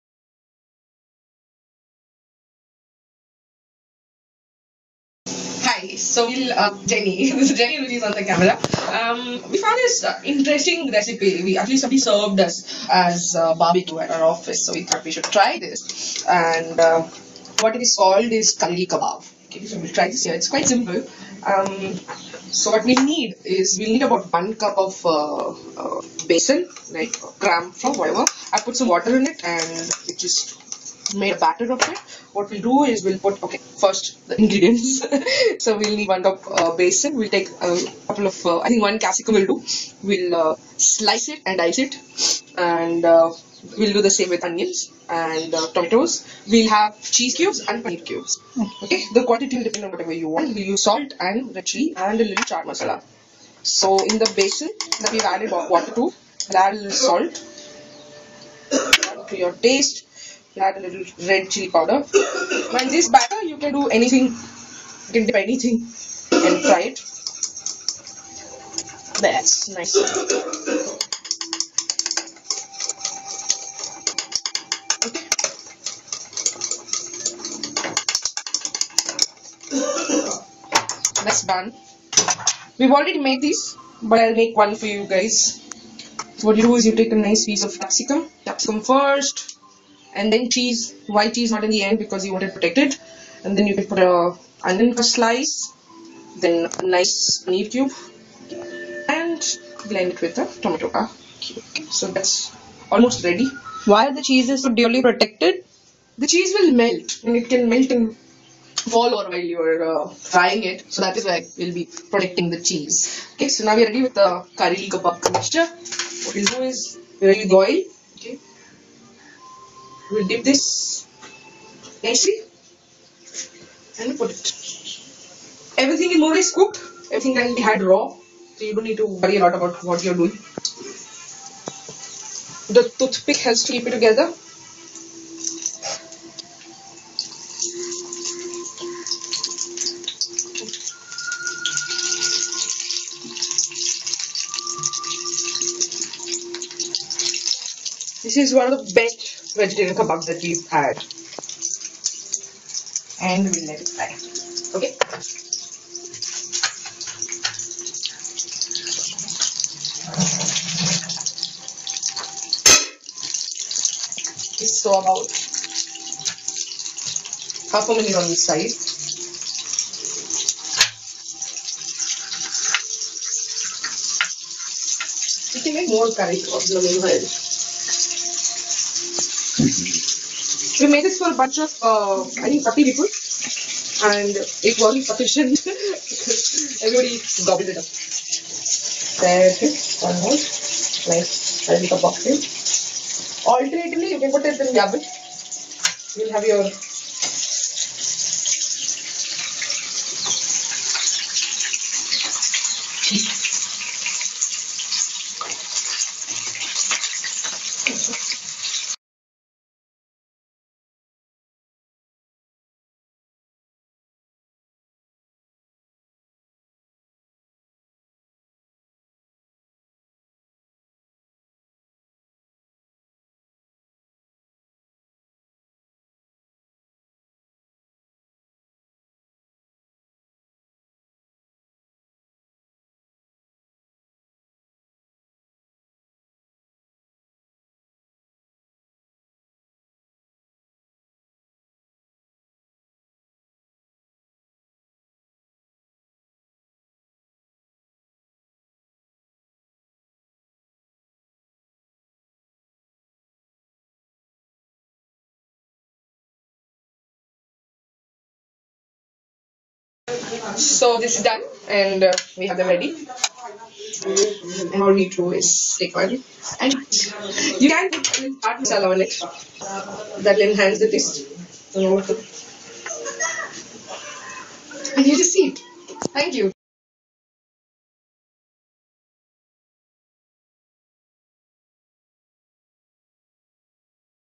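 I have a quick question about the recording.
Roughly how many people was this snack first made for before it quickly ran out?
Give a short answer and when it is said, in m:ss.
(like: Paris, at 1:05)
30, at 3:02.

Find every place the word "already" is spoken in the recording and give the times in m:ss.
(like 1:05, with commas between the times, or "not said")
1:22.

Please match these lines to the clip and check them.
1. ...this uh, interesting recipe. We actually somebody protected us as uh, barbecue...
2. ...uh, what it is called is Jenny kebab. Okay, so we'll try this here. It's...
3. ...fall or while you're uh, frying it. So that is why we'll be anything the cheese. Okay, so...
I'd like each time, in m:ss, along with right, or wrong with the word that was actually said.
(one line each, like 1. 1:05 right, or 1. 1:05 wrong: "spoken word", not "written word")
1. 0:09 wrong: "served", not "protected"
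2. 0:16 wrong: "Kareli", not "Jenny"
3. 1:48 wrong: "protecting", not "anything".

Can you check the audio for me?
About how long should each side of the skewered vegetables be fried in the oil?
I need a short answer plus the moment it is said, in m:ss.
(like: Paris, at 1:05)
half a minute, at 2:47.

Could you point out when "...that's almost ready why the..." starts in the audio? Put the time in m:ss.
1:42.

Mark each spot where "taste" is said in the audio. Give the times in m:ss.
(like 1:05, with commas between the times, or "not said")
0:59, 4:30.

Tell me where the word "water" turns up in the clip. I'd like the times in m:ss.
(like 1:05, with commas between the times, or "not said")
0:28, 0:55.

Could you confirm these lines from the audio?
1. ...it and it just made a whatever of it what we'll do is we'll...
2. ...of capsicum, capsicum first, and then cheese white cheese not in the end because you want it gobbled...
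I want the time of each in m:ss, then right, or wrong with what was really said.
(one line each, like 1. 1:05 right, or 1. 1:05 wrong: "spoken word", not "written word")
1. 0:29 wrong: "batter", not "whatever"
2. 1:27 wrong: "protected", not "gobbled".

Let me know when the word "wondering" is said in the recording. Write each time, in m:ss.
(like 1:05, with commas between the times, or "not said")
not said.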